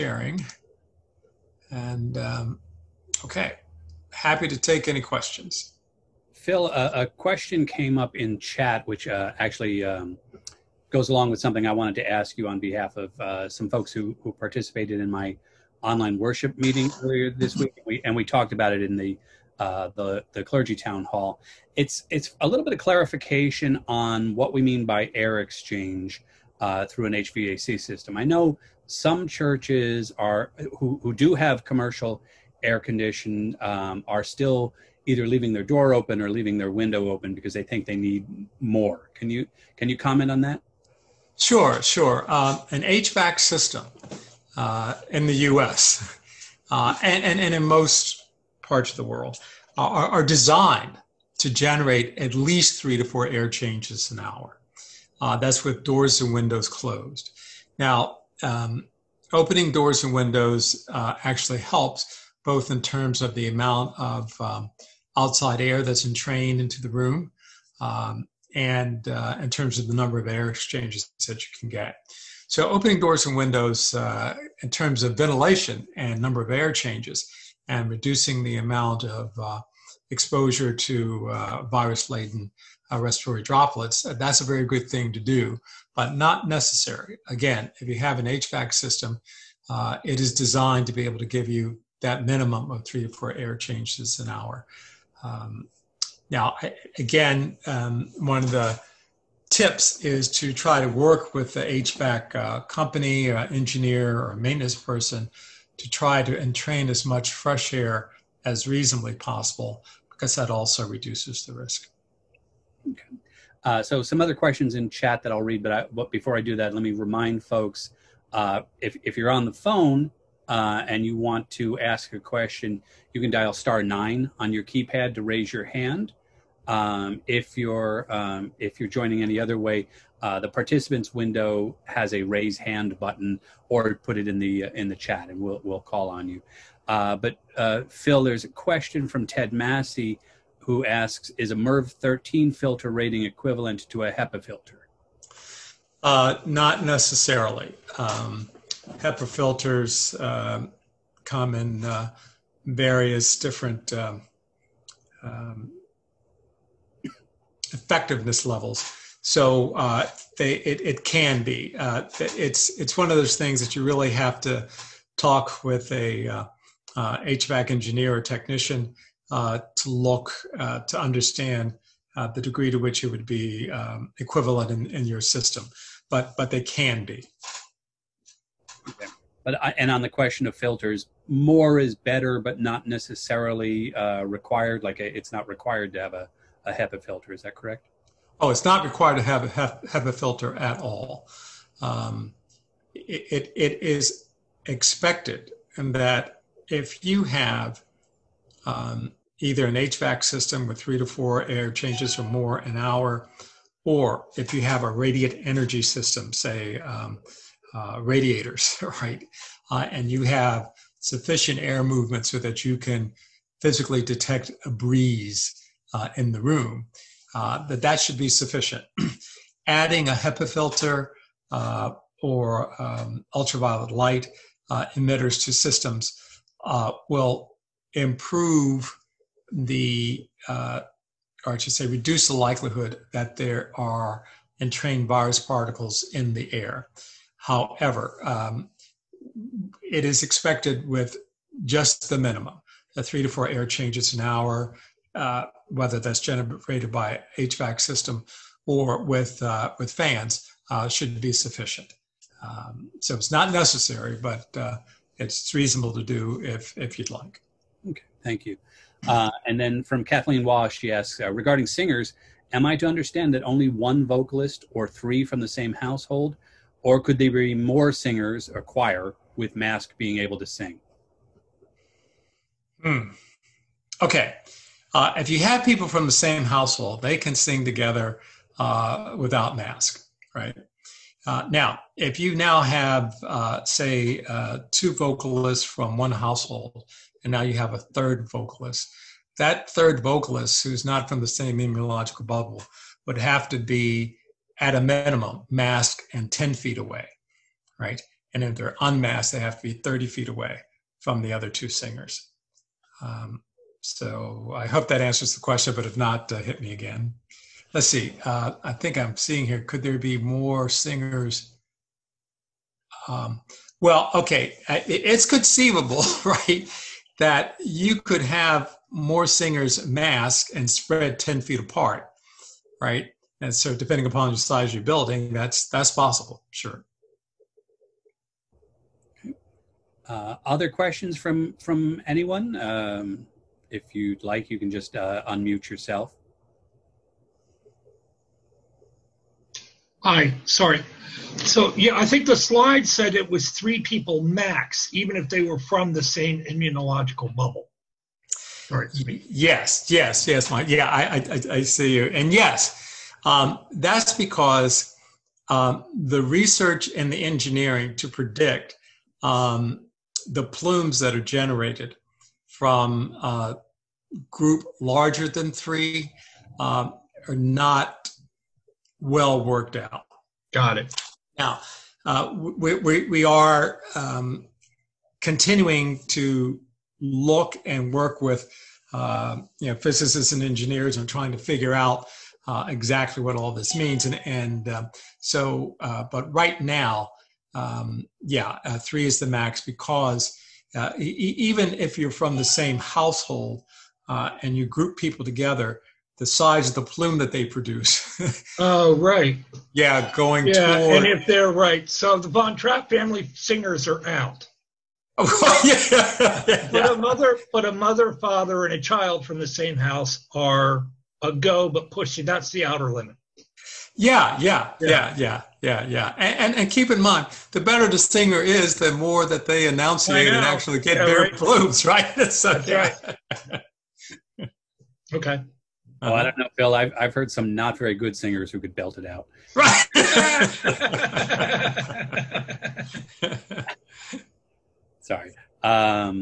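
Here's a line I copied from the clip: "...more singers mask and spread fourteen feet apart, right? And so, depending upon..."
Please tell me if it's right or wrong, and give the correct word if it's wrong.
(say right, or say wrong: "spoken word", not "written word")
wrong: "ten", not "fourteen".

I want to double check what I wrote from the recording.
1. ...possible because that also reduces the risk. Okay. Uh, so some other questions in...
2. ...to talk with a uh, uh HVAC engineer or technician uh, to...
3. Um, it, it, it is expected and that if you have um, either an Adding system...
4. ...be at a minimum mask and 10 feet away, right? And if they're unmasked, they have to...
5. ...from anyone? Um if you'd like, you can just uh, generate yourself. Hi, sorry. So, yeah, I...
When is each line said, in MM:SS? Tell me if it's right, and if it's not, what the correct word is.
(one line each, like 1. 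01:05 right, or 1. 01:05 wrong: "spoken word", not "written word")
1. 01:49 right
2. 02:44 right
3. 03:11 wrong: "HVAC", not "Adding"
4. 04:53 right
5. 05:31 wrong: "unmute", not "generate".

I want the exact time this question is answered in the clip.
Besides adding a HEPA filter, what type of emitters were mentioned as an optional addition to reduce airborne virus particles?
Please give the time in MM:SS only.
03:43.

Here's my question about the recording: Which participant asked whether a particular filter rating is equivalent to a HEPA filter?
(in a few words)
Ted Massey.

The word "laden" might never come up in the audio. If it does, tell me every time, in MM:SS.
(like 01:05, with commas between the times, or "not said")
01:21.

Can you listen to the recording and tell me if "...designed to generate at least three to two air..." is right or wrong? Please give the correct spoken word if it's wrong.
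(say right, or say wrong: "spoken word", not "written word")
wrong: "four", not "two".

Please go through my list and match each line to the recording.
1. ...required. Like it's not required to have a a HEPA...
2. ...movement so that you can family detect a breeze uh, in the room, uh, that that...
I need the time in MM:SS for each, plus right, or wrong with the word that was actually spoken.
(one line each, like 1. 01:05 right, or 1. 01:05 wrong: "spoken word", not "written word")
1. 03:04 right
2. 03:31 wrong: "physically", not "family".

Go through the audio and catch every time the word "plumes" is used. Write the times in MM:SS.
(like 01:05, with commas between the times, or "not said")
06:00, 06:36, 07:01.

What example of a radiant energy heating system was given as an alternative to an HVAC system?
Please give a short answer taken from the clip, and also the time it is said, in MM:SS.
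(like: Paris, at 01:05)
radiators, at 03:28.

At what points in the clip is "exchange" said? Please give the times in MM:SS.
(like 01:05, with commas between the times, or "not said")
00:25, 01:10.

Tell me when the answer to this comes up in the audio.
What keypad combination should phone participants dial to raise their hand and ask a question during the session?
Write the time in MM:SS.
02:03.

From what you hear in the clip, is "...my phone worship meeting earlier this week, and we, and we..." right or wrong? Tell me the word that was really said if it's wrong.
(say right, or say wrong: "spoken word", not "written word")
wrong: "online", not "phone".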